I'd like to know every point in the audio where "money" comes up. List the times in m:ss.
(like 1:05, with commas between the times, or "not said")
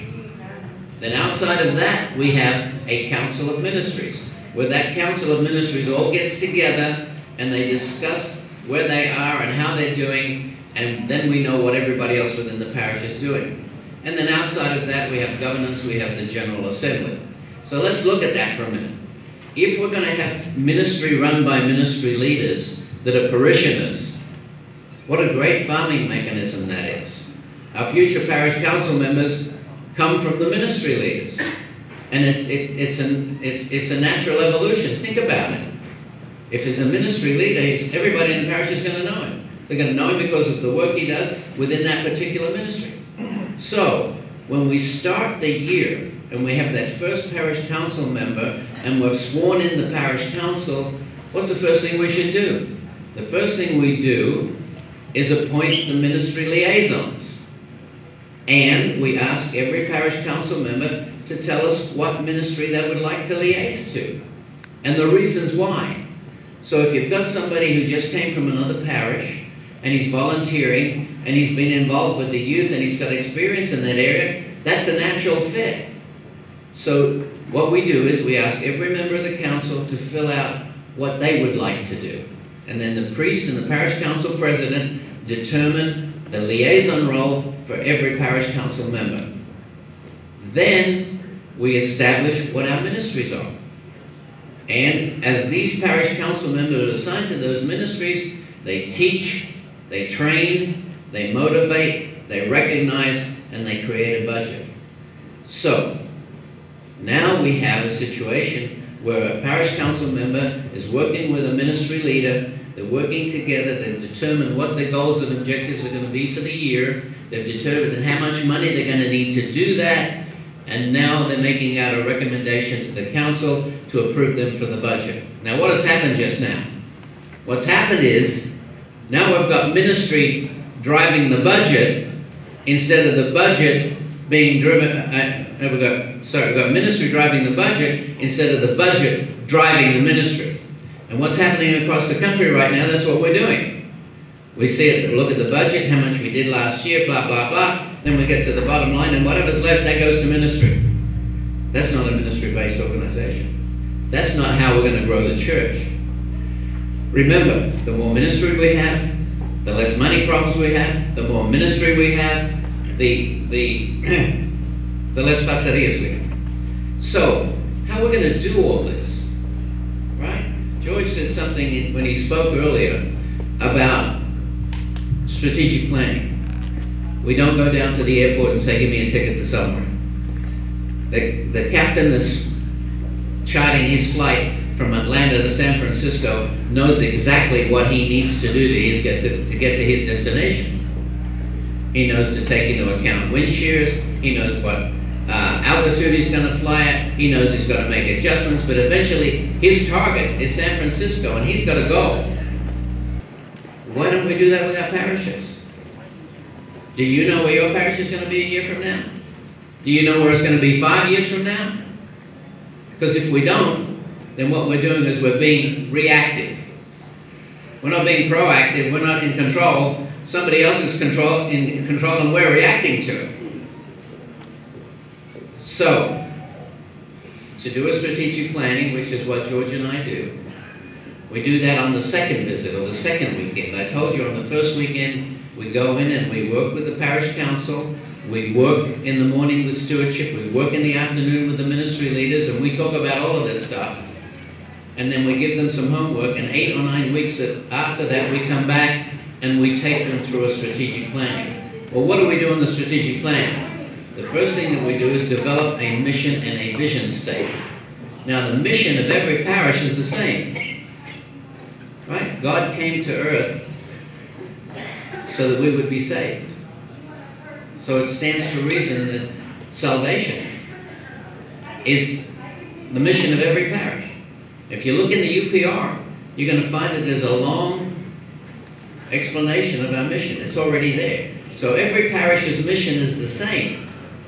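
1:58, 2:39.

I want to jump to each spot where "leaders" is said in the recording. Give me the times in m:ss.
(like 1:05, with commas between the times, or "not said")
0:22, 0:30, 0:37, 1:52, 4:02.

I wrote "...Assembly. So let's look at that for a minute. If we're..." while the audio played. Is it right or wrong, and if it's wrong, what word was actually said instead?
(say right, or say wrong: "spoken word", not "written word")
right.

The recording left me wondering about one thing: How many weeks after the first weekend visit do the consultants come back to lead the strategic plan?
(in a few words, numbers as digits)
8 or 9.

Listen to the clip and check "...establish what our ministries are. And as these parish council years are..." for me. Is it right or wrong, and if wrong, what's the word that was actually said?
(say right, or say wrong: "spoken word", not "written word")
wrong: "members", not "years".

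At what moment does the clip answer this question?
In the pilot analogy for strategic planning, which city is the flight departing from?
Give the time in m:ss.
3:04.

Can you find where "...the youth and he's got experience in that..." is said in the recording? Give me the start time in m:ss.
1:12.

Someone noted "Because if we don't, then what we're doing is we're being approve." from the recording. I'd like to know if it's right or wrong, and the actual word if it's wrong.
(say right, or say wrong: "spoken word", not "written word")
wrong: "reactive", not "approve".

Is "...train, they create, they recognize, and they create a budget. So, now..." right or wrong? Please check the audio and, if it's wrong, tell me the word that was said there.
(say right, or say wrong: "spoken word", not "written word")
wrong: "motivate", not "create".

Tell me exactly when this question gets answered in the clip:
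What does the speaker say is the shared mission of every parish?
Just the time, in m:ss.
4:29.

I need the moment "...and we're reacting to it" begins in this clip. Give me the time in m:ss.
3:42.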